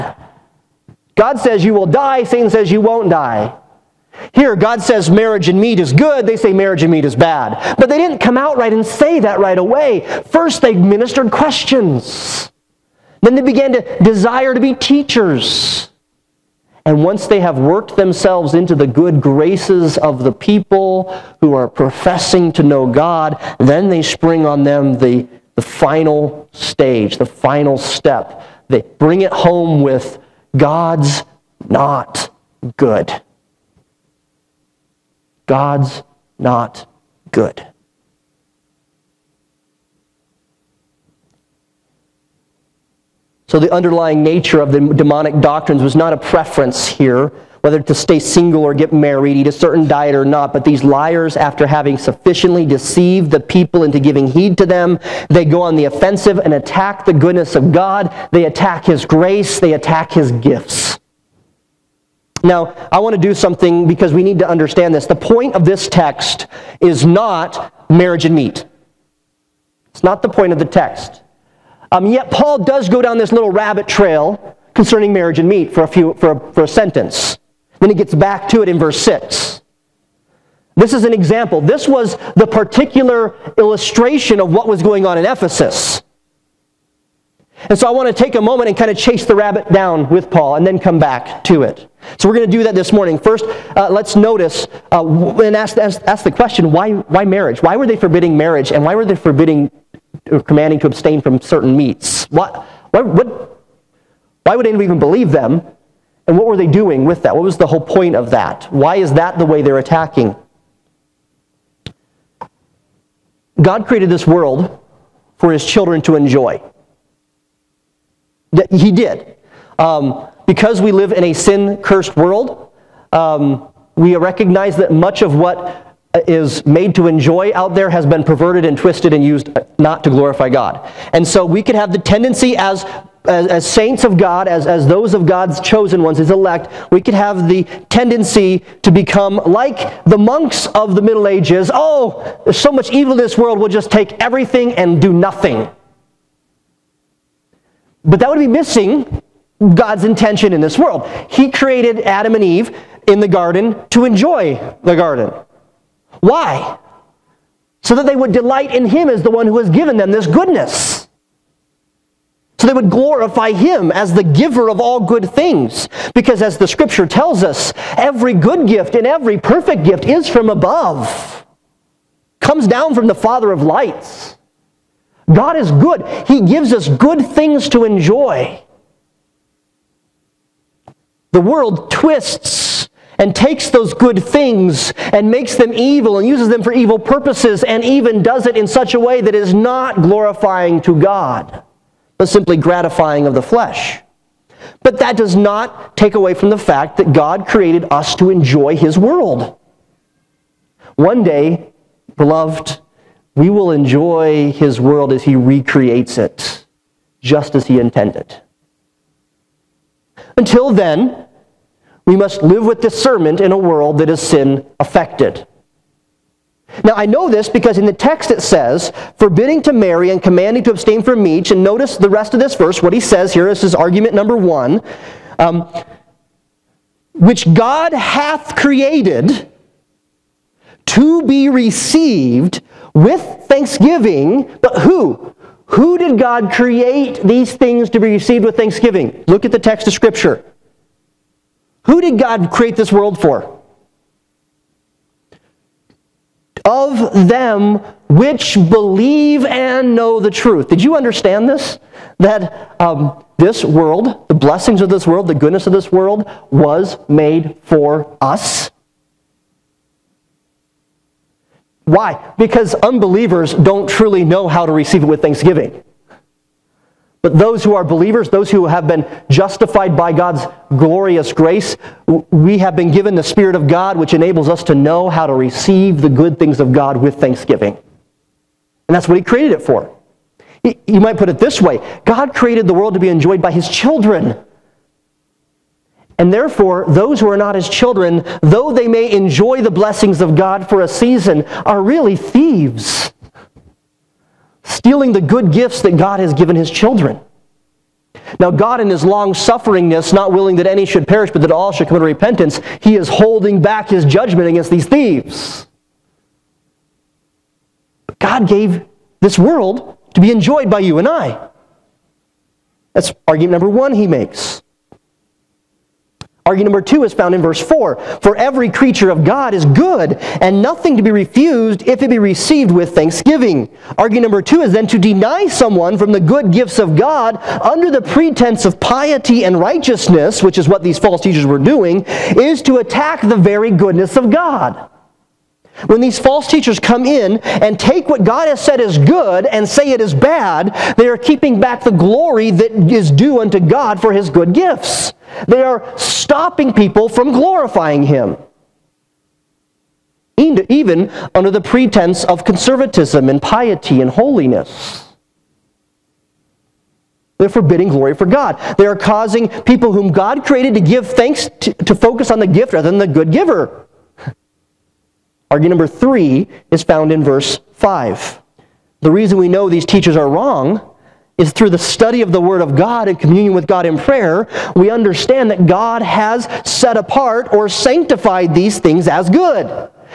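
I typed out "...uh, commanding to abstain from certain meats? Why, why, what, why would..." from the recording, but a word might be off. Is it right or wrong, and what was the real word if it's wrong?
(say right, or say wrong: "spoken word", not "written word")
right.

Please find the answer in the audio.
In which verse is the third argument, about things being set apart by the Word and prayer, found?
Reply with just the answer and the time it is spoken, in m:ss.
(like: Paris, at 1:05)
verse 5, at 6:07.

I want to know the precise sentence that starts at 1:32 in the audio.
So we're going to do that this morning.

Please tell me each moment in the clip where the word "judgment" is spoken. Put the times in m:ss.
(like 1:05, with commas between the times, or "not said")
5:04.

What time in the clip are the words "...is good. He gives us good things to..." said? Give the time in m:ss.
2:55.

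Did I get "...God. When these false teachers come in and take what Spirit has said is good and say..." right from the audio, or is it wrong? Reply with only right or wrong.
wrong.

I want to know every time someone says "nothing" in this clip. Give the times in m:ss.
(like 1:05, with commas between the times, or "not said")
2:25, 5:20.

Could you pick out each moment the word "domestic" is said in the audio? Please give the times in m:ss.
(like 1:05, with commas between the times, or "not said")
not said.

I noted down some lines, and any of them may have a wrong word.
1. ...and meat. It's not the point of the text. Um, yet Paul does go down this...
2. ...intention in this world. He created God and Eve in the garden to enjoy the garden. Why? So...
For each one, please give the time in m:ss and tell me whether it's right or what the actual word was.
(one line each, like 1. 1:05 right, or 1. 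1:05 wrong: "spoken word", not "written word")
1. 1:08 right
2. 2:30 wrong: "Adam", not "God".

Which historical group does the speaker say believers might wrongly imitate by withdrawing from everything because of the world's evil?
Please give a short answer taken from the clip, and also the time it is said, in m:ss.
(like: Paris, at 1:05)
monks of the Middle Ages, at 2:20.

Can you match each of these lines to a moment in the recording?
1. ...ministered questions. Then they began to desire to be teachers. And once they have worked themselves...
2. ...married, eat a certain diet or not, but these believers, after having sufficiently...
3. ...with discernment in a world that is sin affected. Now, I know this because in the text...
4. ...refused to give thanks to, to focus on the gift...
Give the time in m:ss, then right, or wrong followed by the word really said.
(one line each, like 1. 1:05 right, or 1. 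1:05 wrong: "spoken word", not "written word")
1. 0:10 right
2. 0:48 wrong: "liars", not "believers"
3. 3:32 right
4. 6:00 wrong: "created", not "refused".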